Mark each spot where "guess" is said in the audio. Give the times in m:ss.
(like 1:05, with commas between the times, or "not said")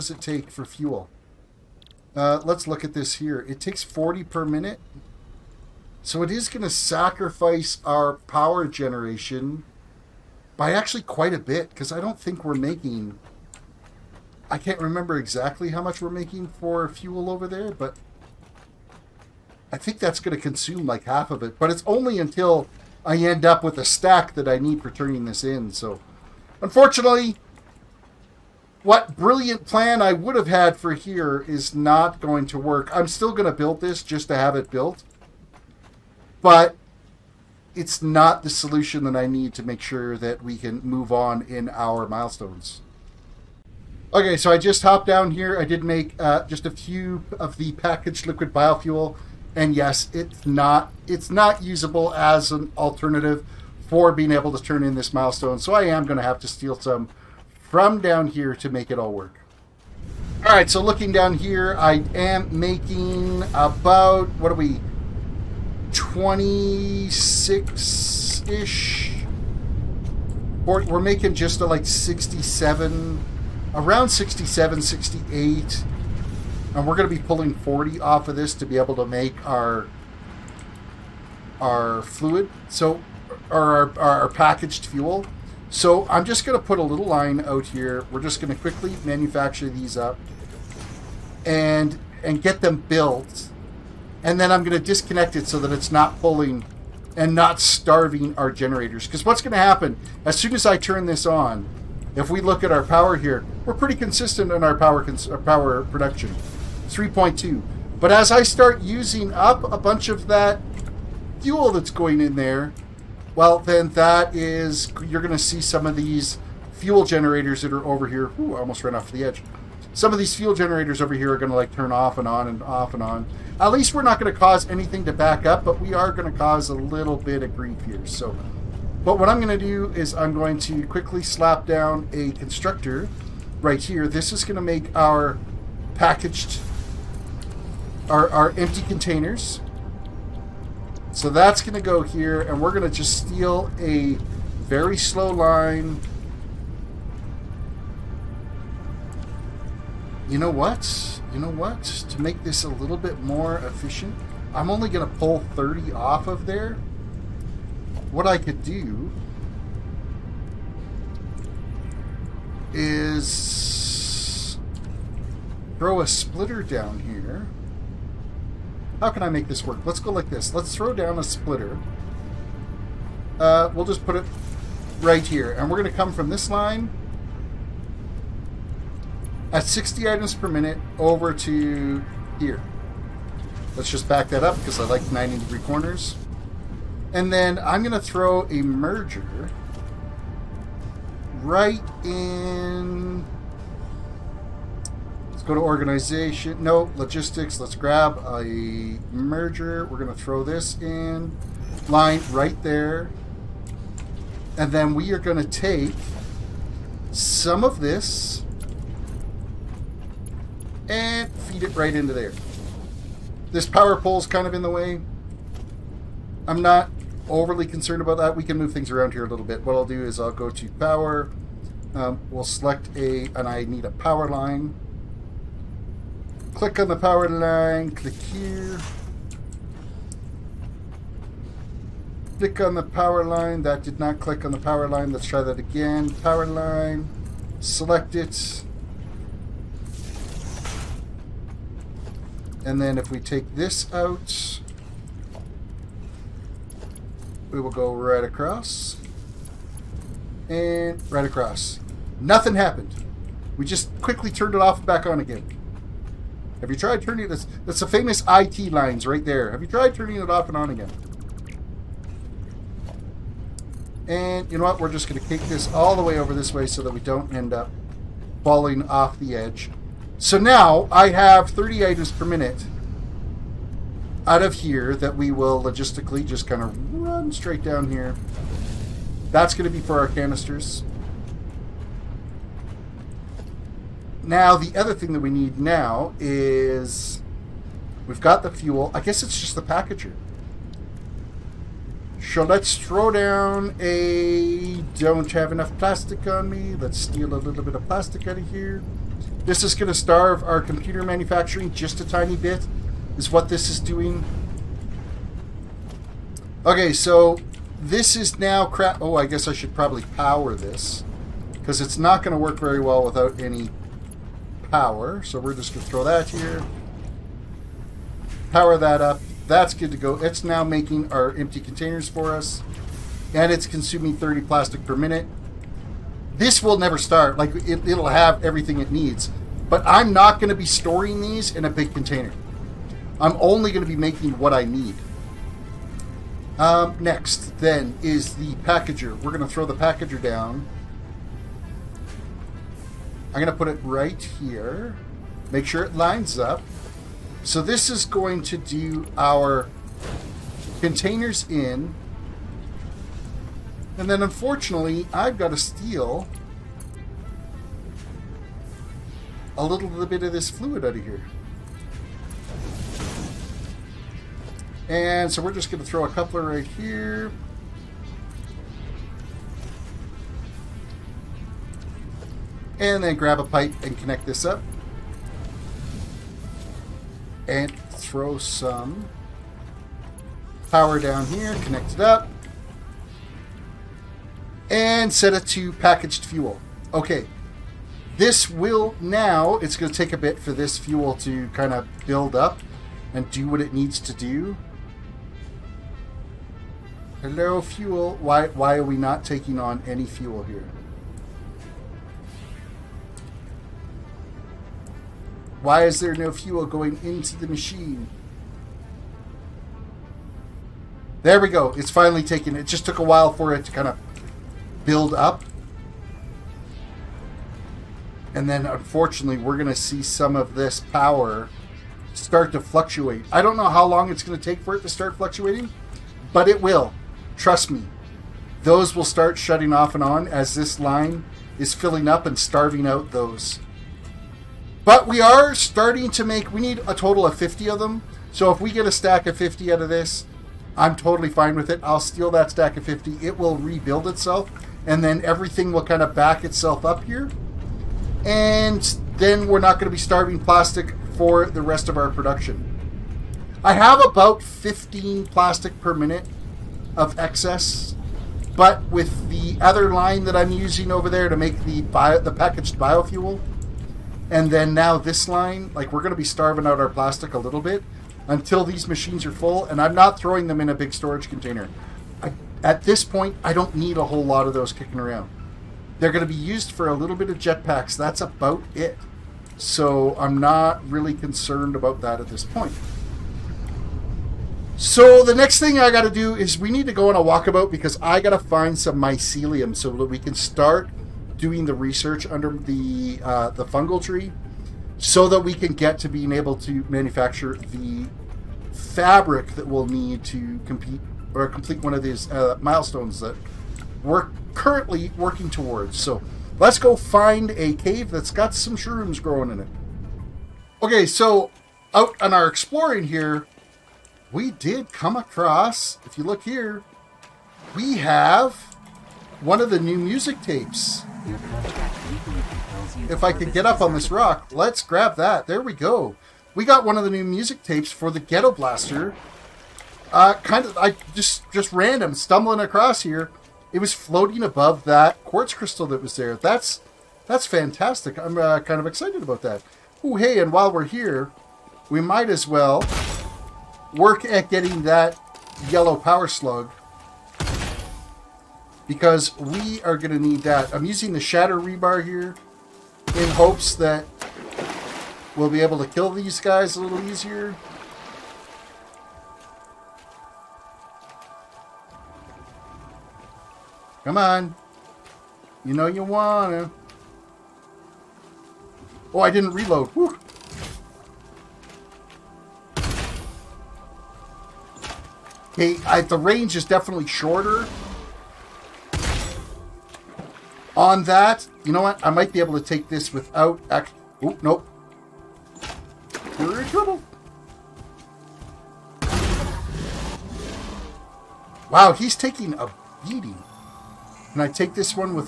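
4:49, 5:09.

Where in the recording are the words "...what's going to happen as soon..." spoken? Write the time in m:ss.
1:39.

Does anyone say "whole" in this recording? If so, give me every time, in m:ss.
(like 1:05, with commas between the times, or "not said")
7:54.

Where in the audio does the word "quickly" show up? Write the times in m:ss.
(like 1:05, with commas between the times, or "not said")
1:28, 2:10, 4:14.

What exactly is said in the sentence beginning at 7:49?
And I'm not throwing them in a big storage container.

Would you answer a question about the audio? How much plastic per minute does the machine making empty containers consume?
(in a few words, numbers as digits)
30.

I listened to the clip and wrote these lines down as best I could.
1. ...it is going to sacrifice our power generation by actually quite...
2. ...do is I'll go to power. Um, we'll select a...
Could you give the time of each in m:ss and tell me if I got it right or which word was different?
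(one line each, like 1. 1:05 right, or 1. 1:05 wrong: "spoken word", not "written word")
1. 0:06 right
2. 3:39 right.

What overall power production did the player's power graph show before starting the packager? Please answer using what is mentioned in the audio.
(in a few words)
3.2.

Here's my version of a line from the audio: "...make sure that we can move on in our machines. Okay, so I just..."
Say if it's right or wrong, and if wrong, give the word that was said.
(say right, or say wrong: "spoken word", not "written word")
wrong: "milestones", not "machines".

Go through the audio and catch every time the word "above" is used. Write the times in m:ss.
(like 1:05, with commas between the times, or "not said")
8:54.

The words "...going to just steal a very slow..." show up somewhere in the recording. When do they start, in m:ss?
2:22.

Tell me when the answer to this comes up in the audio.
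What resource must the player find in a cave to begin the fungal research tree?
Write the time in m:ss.
8:08.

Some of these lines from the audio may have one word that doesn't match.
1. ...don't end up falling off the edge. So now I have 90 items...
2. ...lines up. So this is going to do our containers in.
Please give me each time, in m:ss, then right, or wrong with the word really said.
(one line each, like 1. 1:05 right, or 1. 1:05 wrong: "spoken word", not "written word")
1. 4:27 wrong: "30", not "90"
2. 5:45 right.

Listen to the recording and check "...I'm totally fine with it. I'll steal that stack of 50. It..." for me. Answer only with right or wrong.
right.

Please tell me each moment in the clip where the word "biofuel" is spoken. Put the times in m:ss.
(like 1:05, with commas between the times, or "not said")
0:48, 7:42.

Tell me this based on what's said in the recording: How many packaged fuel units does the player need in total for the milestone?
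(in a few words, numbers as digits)
50.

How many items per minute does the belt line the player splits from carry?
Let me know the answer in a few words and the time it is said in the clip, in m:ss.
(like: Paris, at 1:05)
60, at 2:59.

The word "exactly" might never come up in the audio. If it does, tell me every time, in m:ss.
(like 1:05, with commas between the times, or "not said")
0:15.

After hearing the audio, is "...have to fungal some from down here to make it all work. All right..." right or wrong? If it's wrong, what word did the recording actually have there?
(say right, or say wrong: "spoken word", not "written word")
wrong: "steal", not "fungal".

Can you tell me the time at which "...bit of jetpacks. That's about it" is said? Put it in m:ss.
7:57.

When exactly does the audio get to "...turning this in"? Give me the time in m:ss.
0:24.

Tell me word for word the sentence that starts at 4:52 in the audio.
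So let's throw down a don't have enough plastic on me.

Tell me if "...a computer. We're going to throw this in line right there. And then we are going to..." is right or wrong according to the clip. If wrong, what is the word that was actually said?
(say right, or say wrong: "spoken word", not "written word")
wrong: "merger", not "computer".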